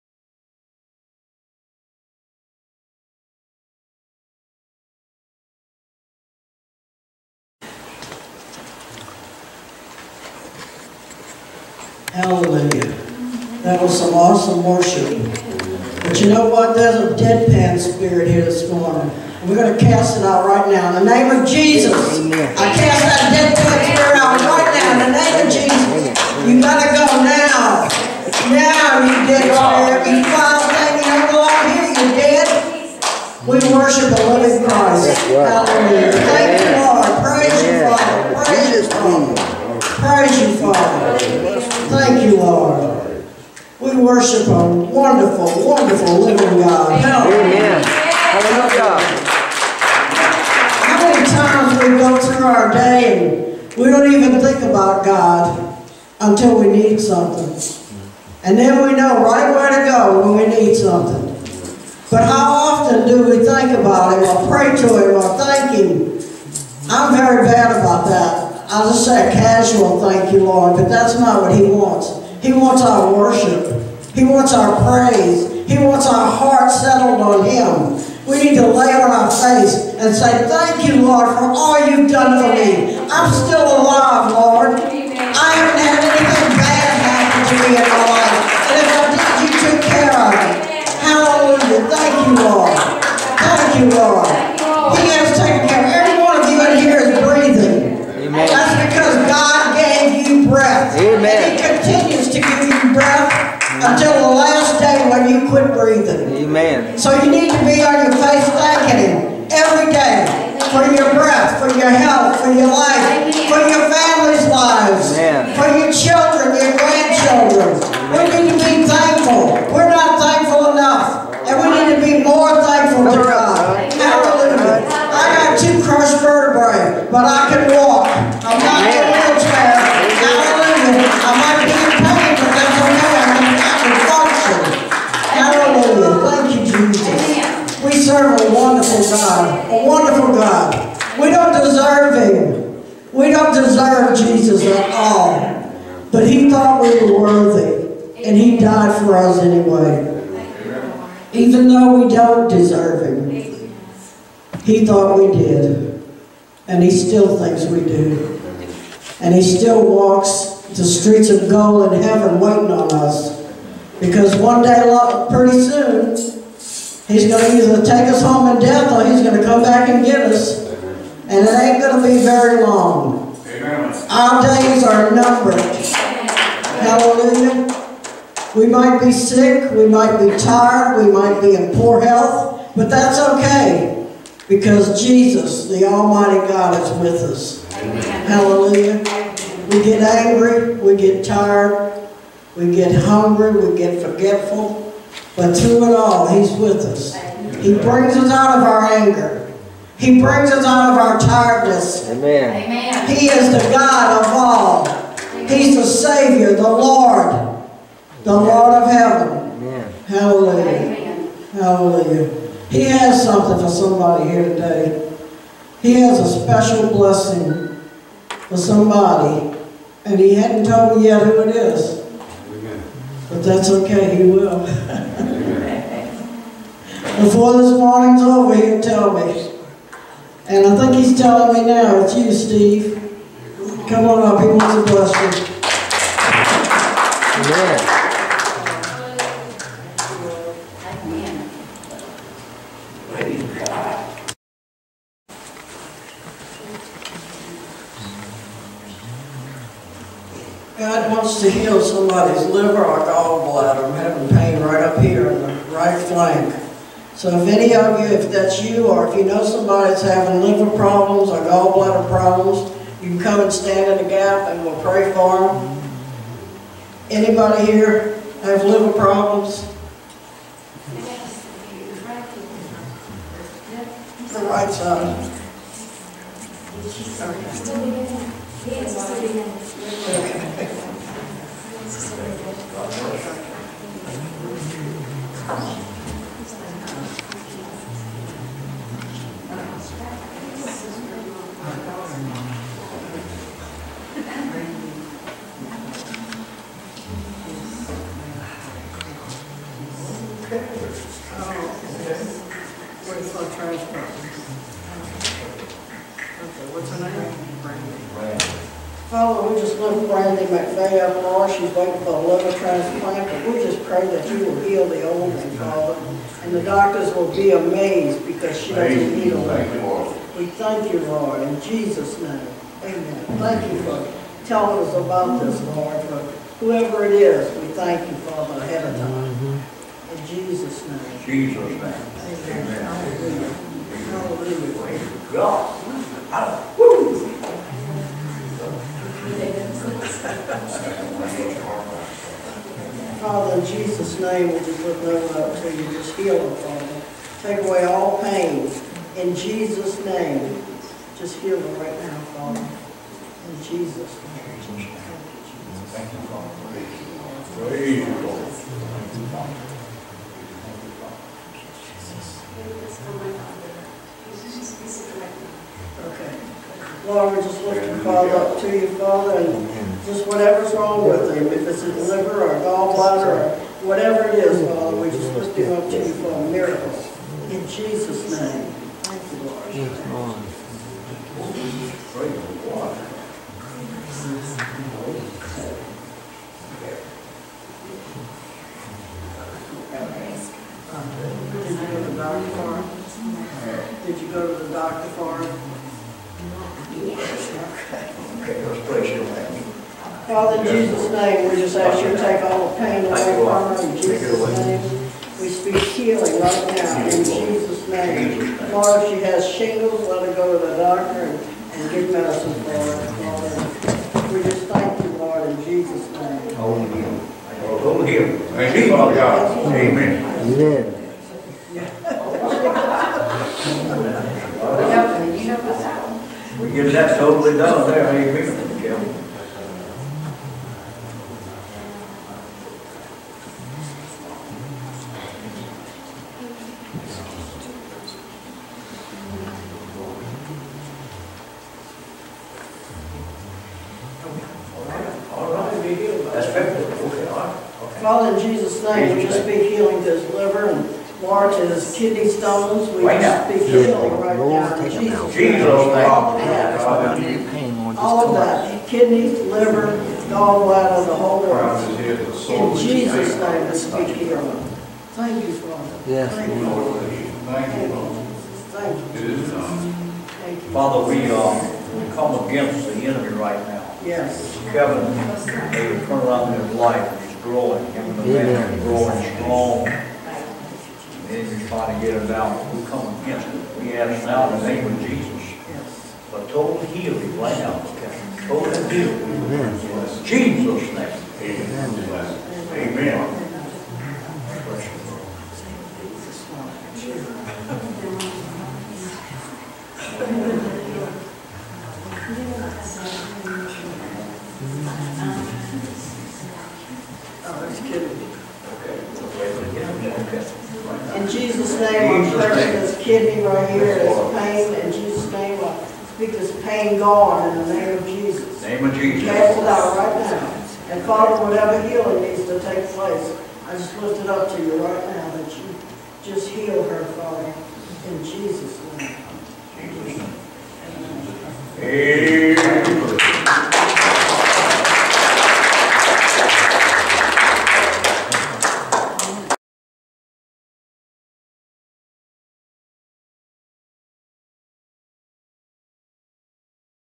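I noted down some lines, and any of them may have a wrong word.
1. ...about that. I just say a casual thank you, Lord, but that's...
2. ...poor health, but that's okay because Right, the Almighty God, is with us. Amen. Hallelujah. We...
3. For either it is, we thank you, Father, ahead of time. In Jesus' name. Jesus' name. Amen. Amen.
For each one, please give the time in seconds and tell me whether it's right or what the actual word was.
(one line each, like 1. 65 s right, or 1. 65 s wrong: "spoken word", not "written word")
1. 67 s right
2. 181 s wrong: "Jesus", not "Right"
3. 326 s wrong: "whoever", not "either".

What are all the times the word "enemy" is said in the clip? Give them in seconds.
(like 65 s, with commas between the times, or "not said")
472 s.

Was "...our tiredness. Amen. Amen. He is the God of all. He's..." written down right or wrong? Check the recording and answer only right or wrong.
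right.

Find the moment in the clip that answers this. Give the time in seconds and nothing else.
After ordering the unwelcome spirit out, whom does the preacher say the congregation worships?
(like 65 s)
34 s.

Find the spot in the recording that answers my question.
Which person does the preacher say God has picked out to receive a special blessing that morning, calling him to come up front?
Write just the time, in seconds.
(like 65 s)
232 s.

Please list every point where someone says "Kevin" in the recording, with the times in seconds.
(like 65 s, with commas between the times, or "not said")
474 s, 488 s.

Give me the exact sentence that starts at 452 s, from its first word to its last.
We Right just speak healing right now.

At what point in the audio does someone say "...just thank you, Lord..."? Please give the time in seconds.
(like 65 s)
414 s.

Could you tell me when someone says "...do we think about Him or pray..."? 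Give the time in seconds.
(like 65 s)
63 s.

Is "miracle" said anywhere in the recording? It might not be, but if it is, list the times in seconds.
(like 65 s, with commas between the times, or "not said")
376 s.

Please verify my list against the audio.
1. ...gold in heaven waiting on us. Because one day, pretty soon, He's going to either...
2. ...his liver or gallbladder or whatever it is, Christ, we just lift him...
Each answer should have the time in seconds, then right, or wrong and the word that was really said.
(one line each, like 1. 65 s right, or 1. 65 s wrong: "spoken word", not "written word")
1. 161 s right
2. 371 s wrong: "Father", not "Christ".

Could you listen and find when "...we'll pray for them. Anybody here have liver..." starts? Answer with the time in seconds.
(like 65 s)
264 s.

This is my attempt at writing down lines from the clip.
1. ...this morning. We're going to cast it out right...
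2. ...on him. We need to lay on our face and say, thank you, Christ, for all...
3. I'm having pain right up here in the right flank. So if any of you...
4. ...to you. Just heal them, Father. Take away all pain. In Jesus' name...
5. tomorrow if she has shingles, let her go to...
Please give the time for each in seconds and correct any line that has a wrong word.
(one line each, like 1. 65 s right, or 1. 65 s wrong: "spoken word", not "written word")
1. 18 s right
2. 77 s wrong: "Lord", not "Christ"
3. 253 s right
4. 345 s right
5. 408 s right.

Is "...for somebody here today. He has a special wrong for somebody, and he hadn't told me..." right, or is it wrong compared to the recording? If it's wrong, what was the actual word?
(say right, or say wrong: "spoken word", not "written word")
wrong: "blessing", not "wrong".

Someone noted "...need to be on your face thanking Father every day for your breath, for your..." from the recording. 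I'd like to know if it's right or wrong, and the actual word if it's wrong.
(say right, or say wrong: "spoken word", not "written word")
wrong: "Him", not "Father".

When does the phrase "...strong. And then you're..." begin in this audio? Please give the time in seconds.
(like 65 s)
479 s.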